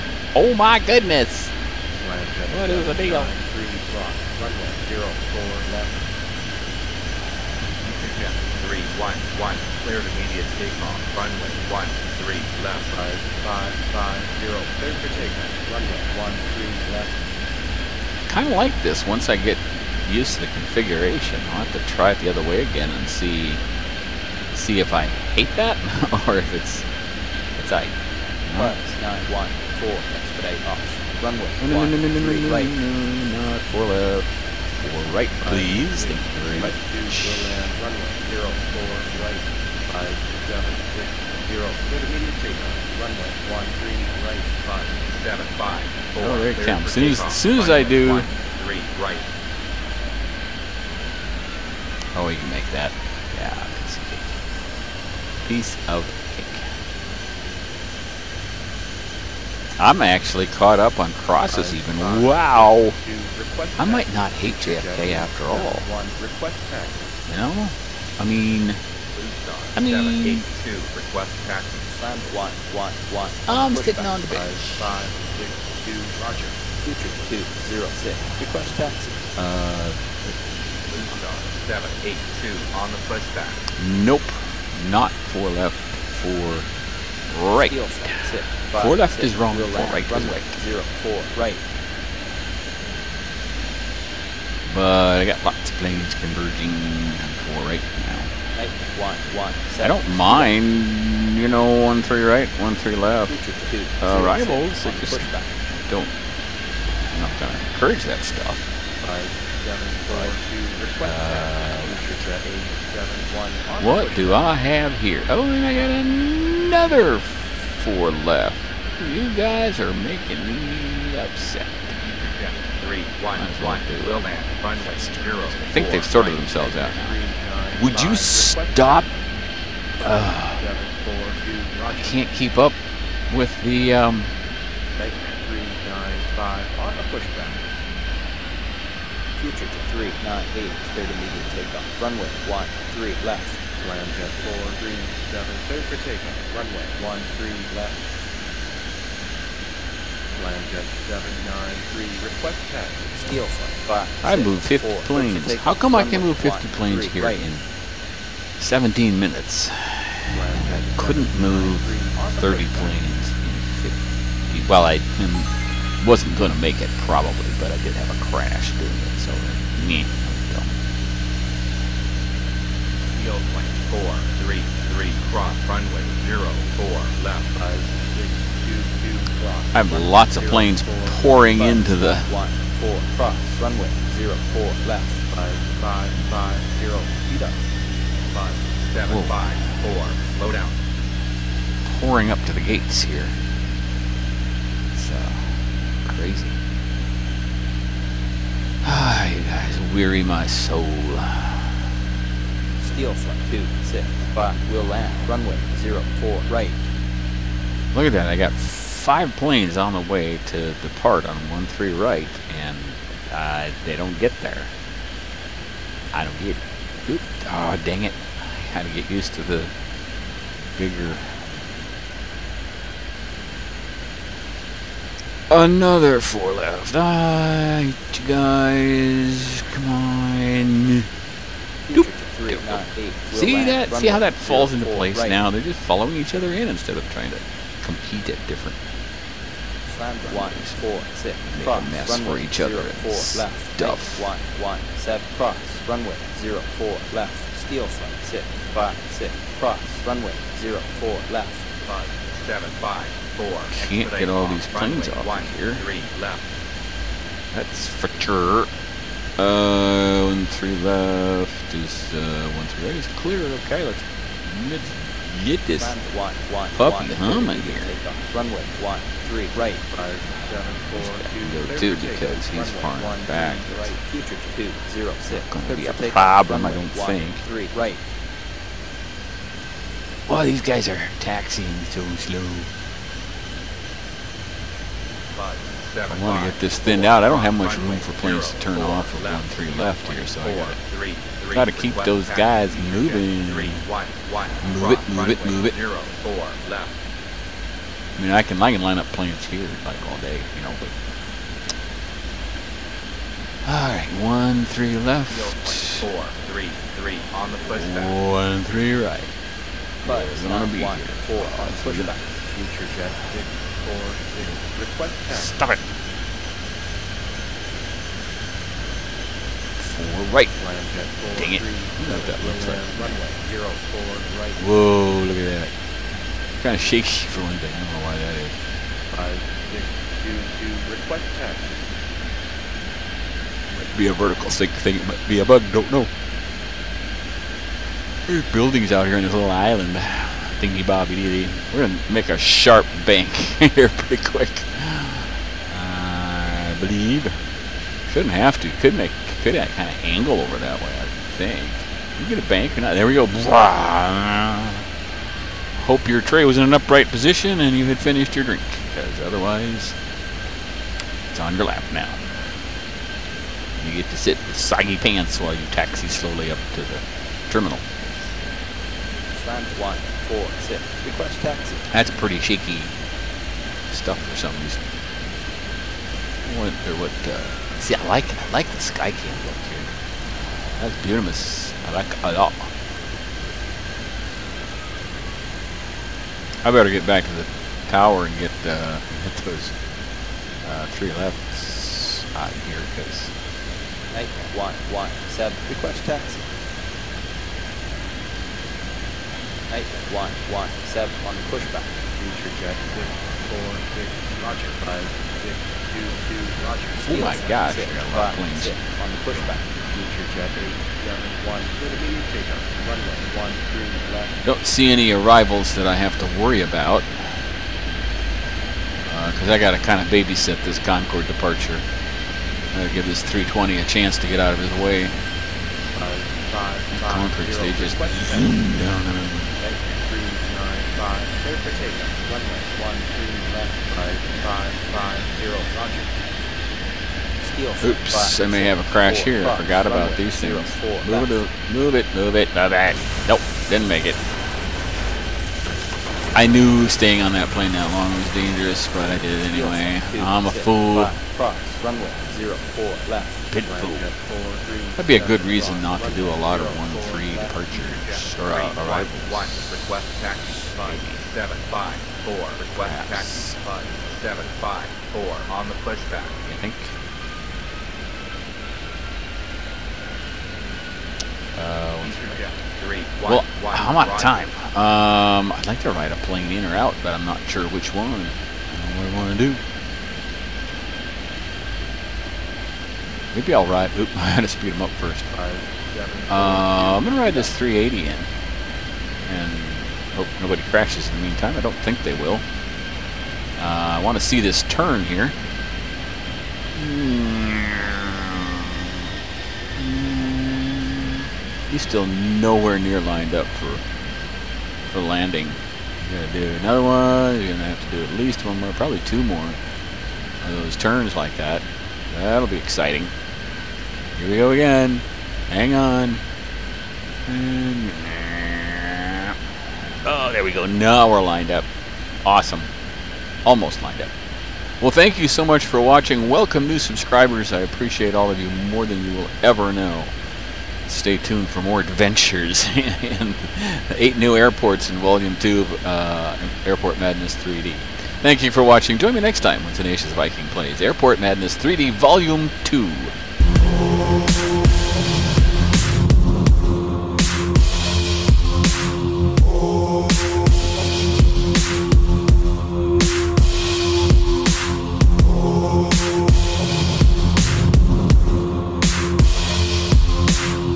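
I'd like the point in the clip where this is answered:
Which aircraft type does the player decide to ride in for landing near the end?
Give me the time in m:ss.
8:07.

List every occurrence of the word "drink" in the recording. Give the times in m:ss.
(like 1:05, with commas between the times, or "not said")
5:58.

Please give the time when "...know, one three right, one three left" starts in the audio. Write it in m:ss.
1:41.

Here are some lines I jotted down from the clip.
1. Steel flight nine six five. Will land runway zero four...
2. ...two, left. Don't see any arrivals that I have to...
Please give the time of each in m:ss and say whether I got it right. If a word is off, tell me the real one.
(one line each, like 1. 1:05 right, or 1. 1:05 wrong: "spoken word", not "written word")
1. 3:22 wrong: "two", not "nine"
2. 6:53 wrong: "three", not "two".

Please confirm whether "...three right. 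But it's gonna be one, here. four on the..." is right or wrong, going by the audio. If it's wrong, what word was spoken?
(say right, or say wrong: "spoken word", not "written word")
right.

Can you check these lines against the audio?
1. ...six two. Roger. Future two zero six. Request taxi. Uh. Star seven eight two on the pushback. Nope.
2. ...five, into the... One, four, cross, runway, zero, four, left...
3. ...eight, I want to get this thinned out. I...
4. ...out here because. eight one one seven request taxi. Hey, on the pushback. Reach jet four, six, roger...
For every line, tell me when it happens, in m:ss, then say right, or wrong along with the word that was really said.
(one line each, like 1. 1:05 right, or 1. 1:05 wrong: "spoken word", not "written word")
1. 1:15 right
2. 3:01 right
3. 4:45 wrong: "seven", not "eight"
4. 6:32 right.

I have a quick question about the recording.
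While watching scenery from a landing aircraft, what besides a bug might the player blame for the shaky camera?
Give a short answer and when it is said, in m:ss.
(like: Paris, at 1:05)
vertical sync, at 5:34.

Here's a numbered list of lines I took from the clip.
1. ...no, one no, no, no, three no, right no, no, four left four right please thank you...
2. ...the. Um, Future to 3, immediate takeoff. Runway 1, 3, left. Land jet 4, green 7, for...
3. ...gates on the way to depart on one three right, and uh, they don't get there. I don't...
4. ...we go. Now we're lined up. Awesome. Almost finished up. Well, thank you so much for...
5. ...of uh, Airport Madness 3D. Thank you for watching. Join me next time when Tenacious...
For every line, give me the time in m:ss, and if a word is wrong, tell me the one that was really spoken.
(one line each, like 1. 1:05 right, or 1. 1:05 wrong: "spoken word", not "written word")
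1. 0:31 right
2. 2:13 right
3. 3:29 wrong: "planes", not "gates"
4. 8:40 wrong: "lined", not "finished"
5. 8:55 right.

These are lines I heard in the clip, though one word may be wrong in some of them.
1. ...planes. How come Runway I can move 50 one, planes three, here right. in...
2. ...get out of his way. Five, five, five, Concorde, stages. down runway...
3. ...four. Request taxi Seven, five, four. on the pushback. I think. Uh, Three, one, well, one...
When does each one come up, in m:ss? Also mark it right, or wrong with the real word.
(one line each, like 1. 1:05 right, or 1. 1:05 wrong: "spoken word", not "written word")
1. 2:35 right
2. 7:04 right
3. 7:42 right.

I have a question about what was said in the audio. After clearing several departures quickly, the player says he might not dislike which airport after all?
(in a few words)
JFK.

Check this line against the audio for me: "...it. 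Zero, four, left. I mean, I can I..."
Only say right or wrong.
right.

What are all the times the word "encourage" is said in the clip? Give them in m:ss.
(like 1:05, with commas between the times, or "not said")
1:47.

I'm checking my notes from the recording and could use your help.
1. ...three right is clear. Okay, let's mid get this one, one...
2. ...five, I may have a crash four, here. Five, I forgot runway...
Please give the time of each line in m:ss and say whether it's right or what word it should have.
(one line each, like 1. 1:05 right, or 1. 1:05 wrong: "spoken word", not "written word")
1. 4:22 right
2. 7:18 right.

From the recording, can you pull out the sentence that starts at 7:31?
Five, cross, runway, zero, four, left.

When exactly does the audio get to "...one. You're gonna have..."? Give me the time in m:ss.
8:26.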